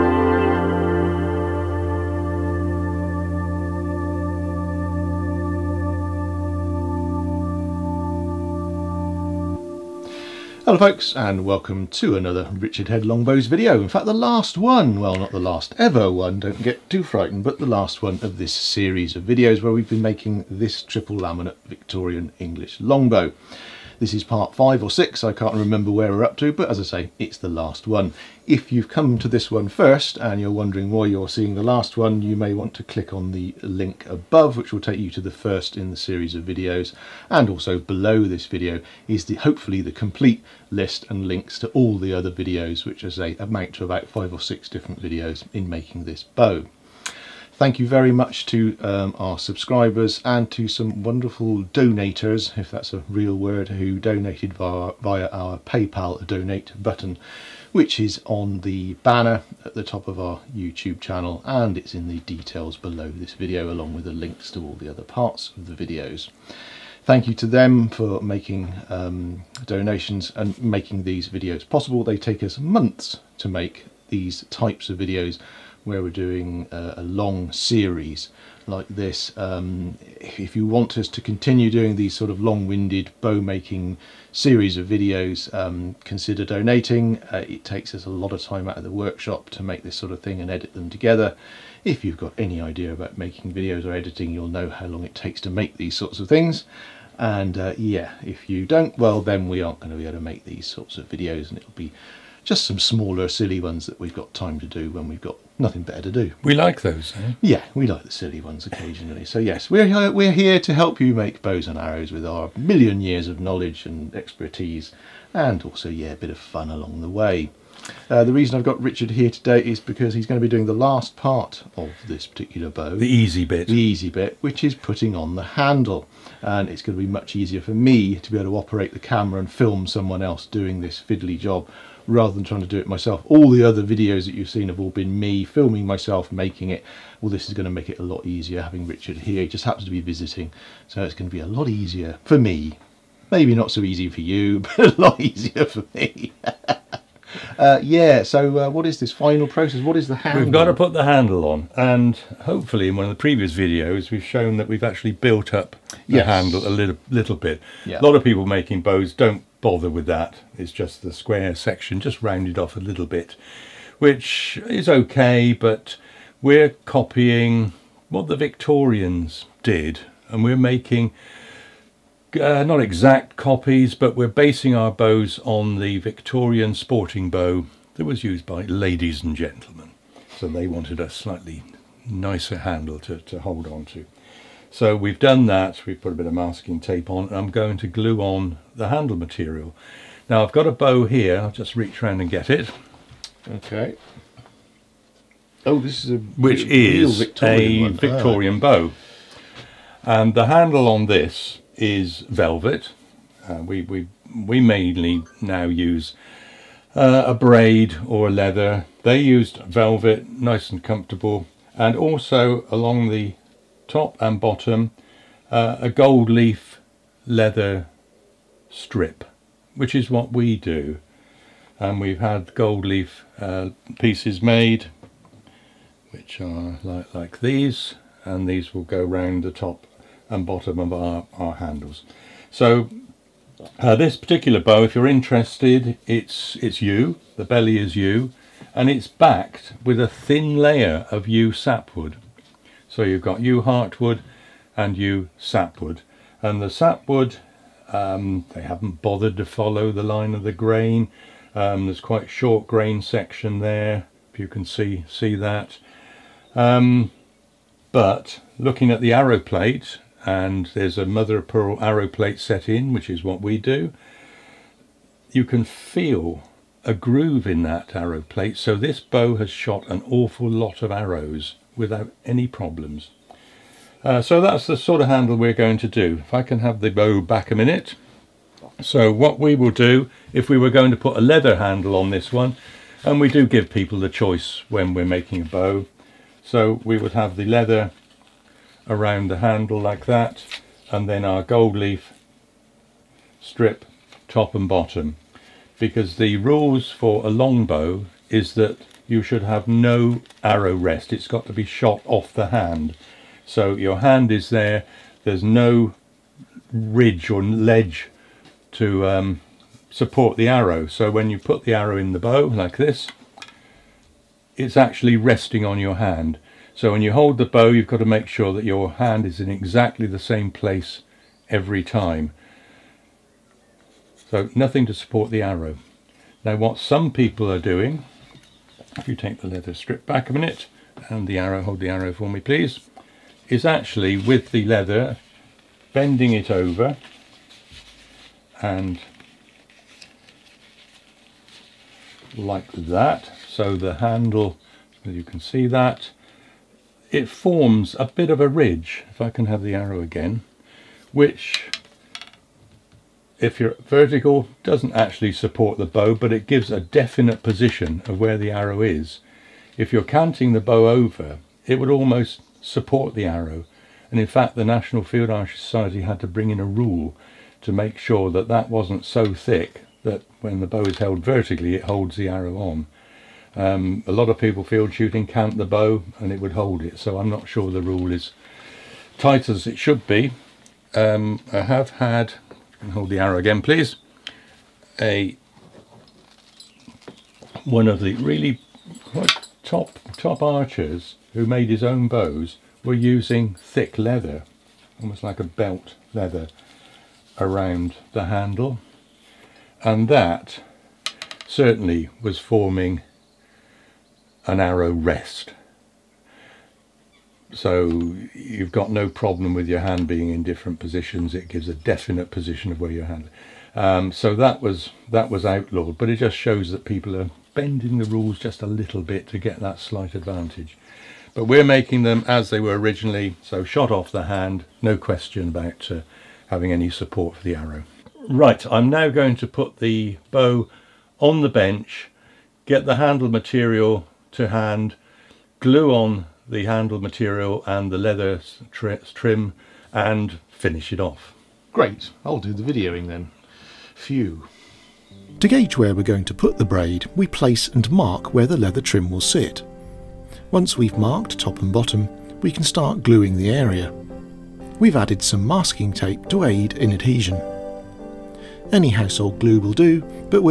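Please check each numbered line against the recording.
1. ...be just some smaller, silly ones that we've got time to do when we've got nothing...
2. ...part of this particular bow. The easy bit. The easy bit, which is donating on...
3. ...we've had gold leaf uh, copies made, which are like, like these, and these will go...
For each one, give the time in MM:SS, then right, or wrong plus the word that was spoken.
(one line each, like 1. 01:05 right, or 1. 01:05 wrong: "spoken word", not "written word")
1. 01:41 right
2. 02:01 wrong: "putting", not "donating"
3. 03:42 wrong: "pieces", not "copies".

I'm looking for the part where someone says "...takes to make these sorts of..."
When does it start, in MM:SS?
01:35.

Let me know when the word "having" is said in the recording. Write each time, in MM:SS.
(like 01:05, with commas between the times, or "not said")
02:18, 07:06.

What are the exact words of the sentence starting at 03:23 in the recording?
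Uh, we we we mainly now use uh, a braid or leather.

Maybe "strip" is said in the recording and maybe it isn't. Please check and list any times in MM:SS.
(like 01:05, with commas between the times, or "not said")
03:38, 04:53, 05:29.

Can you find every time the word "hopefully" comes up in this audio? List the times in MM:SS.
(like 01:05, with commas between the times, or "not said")
00:39, 02:32.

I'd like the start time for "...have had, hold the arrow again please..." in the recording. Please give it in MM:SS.
06:21.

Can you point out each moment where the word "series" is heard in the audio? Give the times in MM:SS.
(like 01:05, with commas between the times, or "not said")
00:18, 00:35, 01:17, 01:24.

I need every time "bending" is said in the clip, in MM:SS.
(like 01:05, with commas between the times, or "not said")
05:35, 06:57.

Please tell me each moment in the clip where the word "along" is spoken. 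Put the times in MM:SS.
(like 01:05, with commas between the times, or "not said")
01:03, 01:56, 03:32.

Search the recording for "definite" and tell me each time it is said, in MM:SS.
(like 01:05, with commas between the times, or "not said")
05:56, 06:51.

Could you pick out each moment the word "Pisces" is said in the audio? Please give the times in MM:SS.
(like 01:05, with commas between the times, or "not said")
not said.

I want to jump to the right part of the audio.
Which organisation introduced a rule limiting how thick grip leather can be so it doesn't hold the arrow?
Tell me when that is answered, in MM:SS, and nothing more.
06:04.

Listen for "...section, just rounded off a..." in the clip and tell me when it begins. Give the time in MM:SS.
02:41.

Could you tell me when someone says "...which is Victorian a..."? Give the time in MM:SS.
03:16.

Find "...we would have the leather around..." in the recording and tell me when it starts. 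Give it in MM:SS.
04:46.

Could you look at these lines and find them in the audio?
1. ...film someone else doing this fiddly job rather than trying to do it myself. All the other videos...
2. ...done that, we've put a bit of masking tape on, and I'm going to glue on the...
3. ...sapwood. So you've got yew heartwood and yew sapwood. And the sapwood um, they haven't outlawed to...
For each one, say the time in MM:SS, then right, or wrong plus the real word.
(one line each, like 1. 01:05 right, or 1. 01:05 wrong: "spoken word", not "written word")
1. 02:09 right
2. 03:05 right
3. 04:01 wrong: "bothered", not "outlawed".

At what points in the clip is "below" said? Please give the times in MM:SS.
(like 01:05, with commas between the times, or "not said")
00:37, 01:02.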